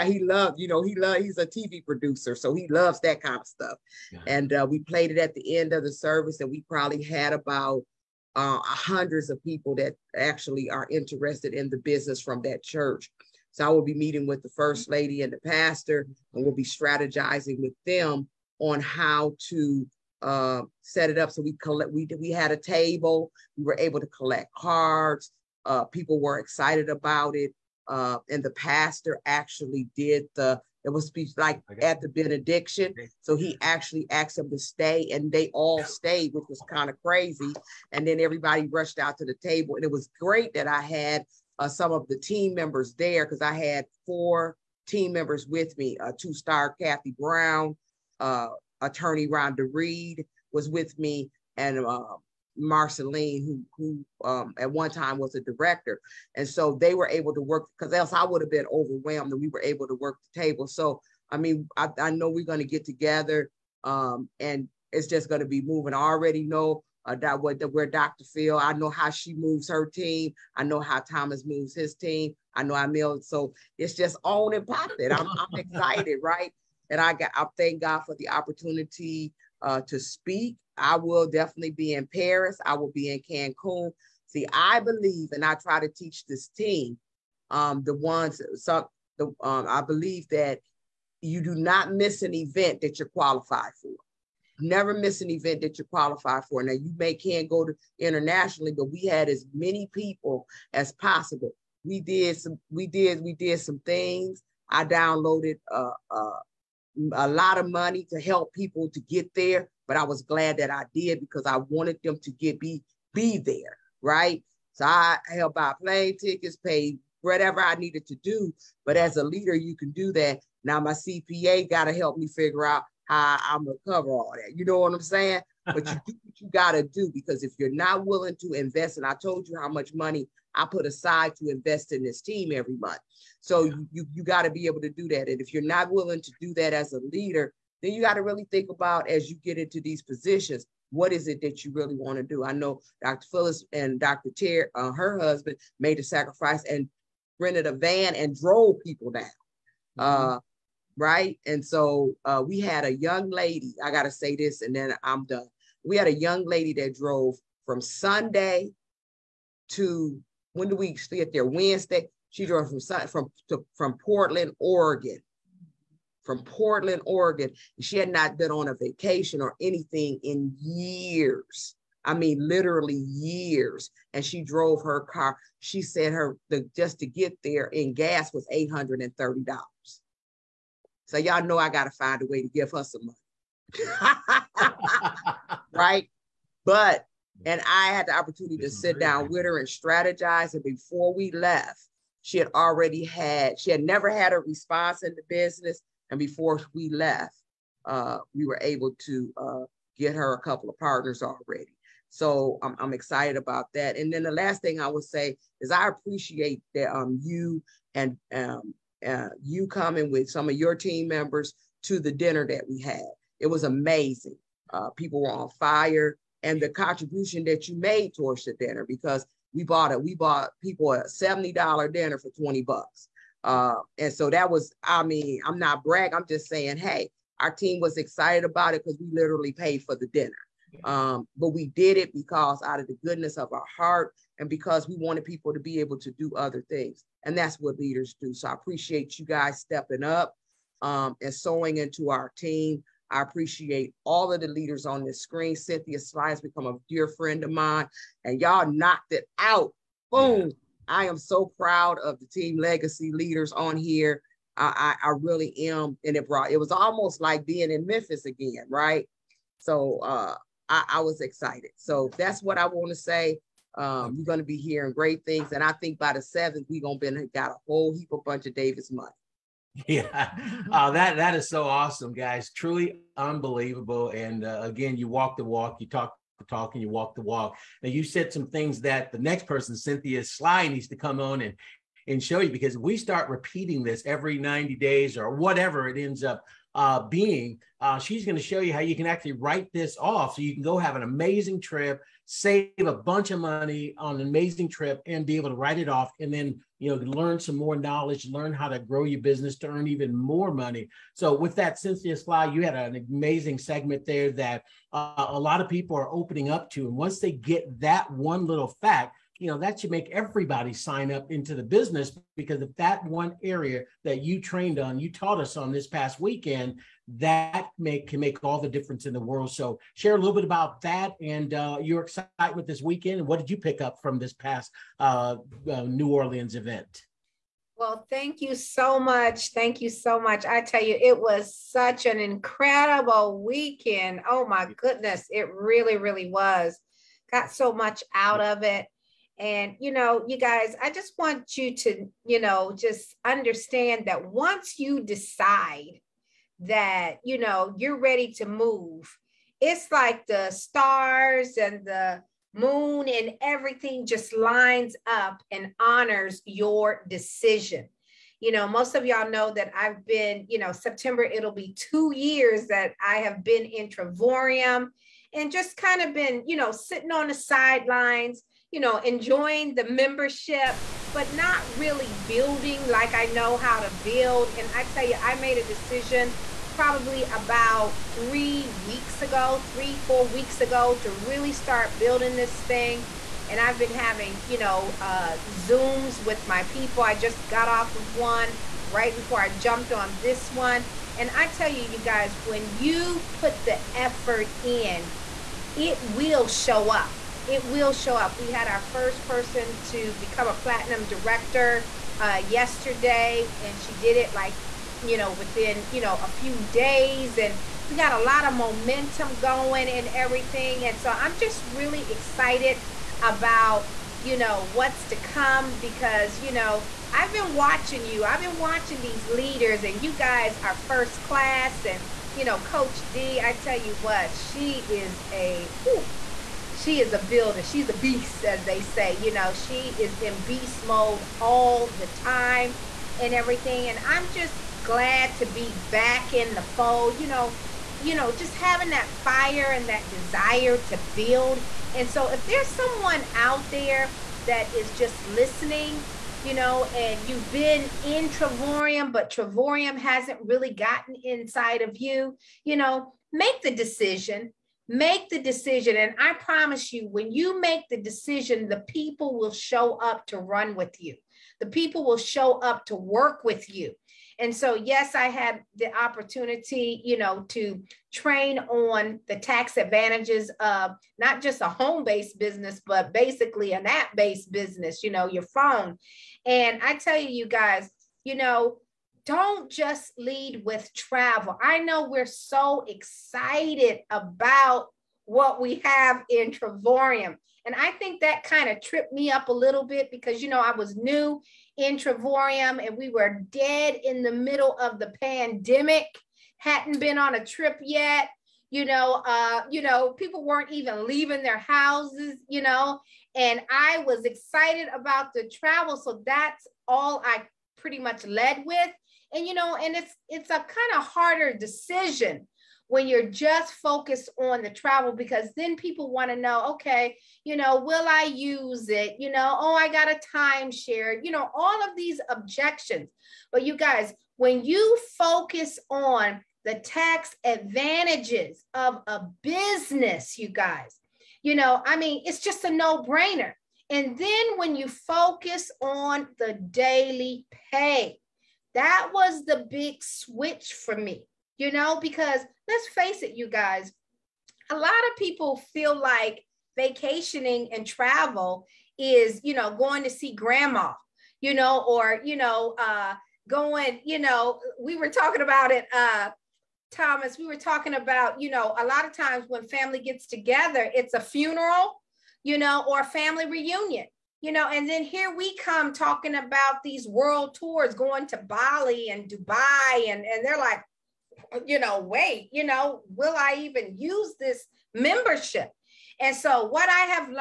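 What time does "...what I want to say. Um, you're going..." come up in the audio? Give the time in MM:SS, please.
04:22.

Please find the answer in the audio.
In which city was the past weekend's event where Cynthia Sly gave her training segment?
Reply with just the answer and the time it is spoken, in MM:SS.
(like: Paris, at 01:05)
New Orleans, at 05:25.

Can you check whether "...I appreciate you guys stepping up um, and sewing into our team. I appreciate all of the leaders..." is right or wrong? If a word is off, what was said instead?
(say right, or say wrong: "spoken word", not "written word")
right.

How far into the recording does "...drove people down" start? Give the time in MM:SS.
02:28.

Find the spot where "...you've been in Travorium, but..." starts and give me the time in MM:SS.
07:27.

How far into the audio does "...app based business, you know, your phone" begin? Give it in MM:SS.
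07:53.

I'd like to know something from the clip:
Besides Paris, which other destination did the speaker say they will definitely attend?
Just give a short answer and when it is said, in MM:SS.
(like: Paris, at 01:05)
Cancun, at 01:23.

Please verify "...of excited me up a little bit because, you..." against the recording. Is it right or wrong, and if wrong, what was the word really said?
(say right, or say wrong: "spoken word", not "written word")
wrong: "tripped", not "excited".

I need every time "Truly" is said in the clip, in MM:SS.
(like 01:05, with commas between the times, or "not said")
04:32.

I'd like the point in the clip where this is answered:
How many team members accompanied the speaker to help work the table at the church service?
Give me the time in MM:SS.
00:44.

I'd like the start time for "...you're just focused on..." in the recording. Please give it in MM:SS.
08:33.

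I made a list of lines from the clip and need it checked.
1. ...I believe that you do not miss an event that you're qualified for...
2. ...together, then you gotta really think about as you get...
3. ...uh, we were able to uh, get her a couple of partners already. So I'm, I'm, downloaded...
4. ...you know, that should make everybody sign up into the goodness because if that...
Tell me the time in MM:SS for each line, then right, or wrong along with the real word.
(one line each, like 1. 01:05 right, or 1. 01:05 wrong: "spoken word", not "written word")
1. 01:29 right
2. 02:17 wrong: "leader", not "together"
3. 03:17 wrong: "excited", not "downloaded"
4. 05:09 wrong: "business", not "goodness".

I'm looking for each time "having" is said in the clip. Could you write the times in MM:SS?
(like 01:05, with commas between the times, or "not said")
06:23, 07:18.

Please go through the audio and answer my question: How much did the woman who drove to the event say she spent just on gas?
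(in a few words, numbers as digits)
$830.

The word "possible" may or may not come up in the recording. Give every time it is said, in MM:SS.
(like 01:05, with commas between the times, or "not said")
01:40.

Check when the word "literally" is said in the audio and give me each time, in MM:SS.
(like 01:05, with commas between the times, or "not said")
02:52, 03:49.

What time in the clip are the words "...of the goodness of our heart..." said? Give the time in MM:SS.
03:52.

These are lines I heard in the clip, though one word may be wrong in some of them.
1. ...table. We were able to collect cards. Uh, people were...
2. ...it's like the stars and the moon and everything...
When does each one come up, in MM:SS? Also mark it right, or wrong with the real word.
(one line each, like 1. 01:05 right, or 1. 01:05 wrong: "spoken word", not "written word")
1. 00:22 right
2. 05:49 right.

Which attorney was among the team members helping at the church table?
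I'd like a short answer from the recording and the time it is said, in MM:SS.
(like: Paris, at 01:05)
Rhonda Reed, at 00:49.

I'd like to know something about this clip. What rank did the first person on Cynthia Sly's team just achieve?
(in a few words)
platinum director.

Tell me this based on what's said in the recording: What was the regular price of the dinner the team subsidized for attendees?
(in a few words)
$70.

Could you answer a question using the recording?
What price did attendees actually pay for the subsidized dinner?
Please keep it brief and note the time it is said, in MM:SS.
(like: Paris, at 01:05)
$20, at 03:42.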